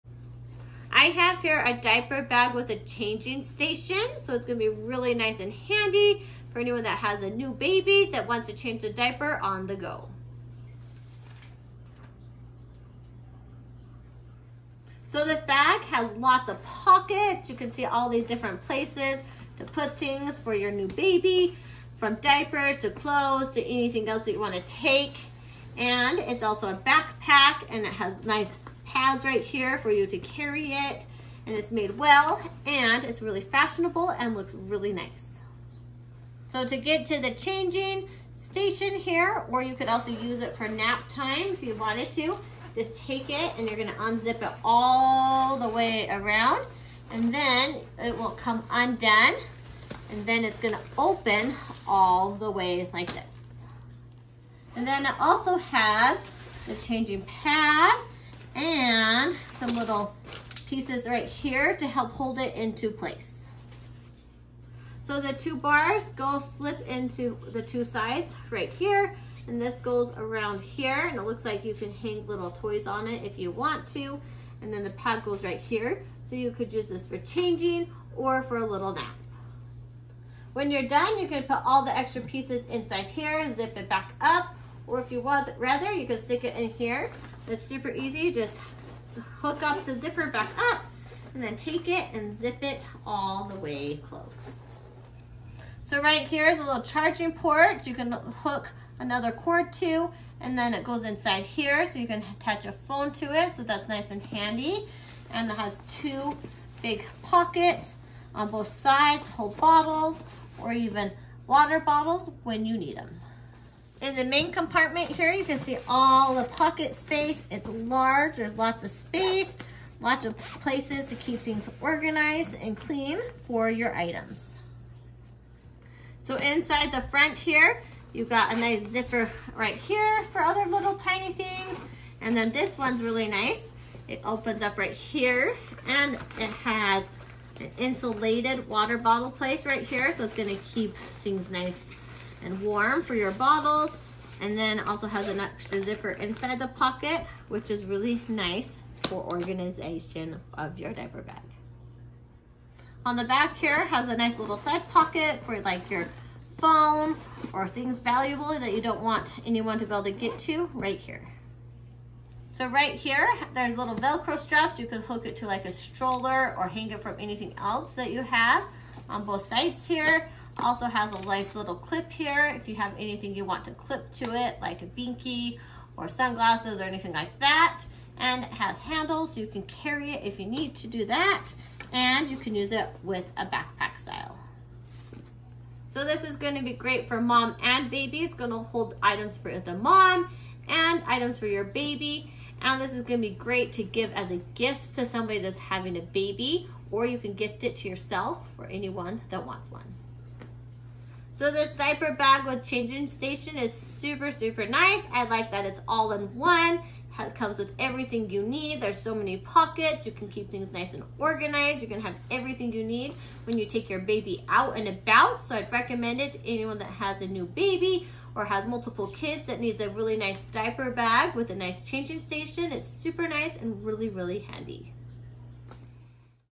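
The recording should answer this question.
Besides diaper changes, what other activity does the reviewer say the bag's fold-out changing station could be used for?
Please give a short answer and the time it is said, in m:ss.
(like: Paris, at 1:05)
Nap time, at 0:40.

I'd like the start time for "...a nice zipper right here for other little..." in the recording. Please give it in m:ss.
2:08.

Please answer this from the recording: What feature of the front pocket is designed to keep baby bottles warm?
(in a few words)
Insulated water bottle place.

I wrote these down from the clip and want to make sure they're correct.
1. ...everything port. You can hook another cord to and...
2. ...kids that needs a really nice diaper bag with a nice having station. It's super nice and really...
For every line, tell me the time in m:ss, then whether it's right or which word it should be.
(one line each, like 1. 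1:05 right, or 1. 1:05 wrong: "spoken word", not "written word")
1. 1:36 wrong: "charging", not "everything"
2. 3:39 wrong: "changing", not "having".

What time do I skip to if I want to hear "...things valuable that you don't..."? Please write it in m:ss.
2:37.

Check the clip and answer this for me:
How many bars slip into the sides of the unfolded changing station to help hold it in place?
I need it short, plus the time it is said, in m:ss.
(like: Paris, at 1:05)
2, at 1:05.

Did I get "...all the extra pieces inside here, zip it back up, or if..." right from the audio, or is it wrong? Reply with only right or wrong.
right.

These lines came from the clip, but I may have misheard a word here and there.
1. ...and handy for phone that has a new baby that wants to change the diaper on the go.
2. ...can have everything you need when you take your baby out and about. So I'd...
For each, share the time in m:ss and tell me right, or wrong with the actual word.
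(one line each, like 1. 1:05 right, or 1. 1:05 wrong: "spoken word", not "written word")
1. 0:05 wrong: "anyone", not "phone"
2. 3:31 right.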